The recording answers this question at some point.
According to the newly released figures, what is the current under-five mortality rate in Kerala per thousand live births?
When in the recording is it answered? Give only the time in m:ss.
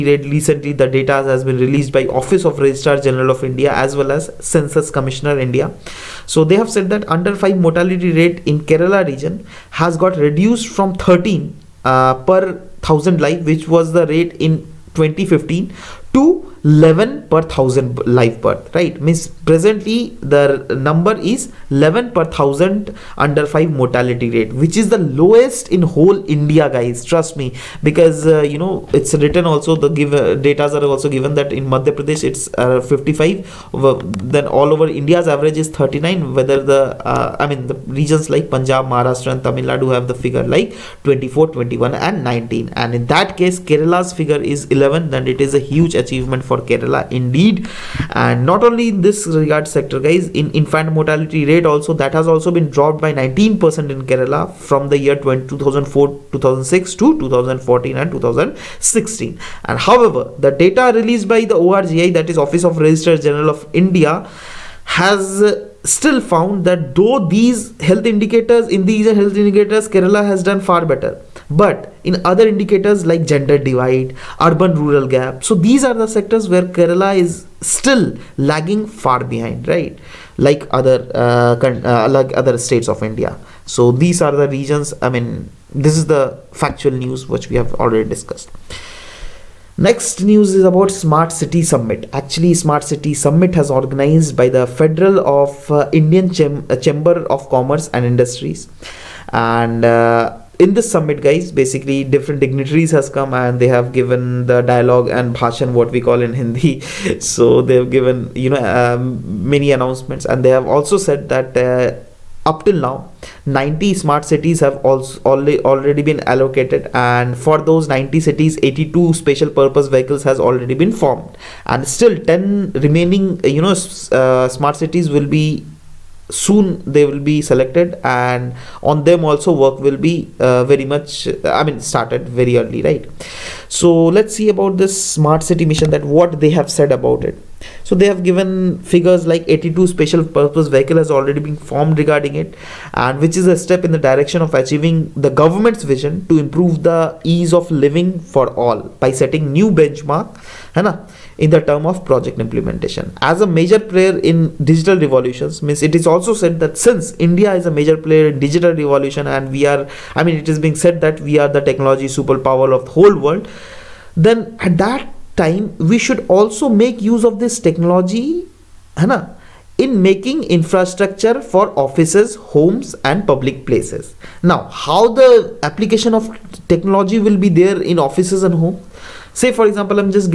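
0:19.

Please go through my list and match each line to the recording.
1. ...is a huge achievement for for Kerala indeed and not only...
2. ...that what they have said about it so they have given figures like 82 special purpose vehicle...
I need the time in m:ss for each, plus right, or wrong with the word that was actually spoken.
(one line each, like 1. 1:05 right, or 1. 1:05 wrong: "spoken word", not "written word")
1. 0:45 right
2. 2:15 right.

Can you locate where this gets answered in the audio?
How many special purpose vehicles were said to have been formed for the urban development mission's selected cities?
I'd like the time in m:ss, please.
1:58.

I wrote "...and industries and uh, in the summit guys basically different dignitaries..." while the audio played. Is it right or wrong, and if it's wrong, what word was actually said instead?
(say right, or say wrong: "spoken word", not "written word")
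right.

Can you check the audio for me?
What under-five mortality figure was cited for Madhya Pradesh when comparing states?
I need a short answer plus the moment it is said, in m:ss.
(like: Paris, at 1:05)
55, at 0:31.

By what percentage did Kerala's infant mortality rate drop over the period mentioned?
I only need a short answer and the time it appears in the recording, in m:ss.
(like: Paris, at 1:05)
19%, at 0:52.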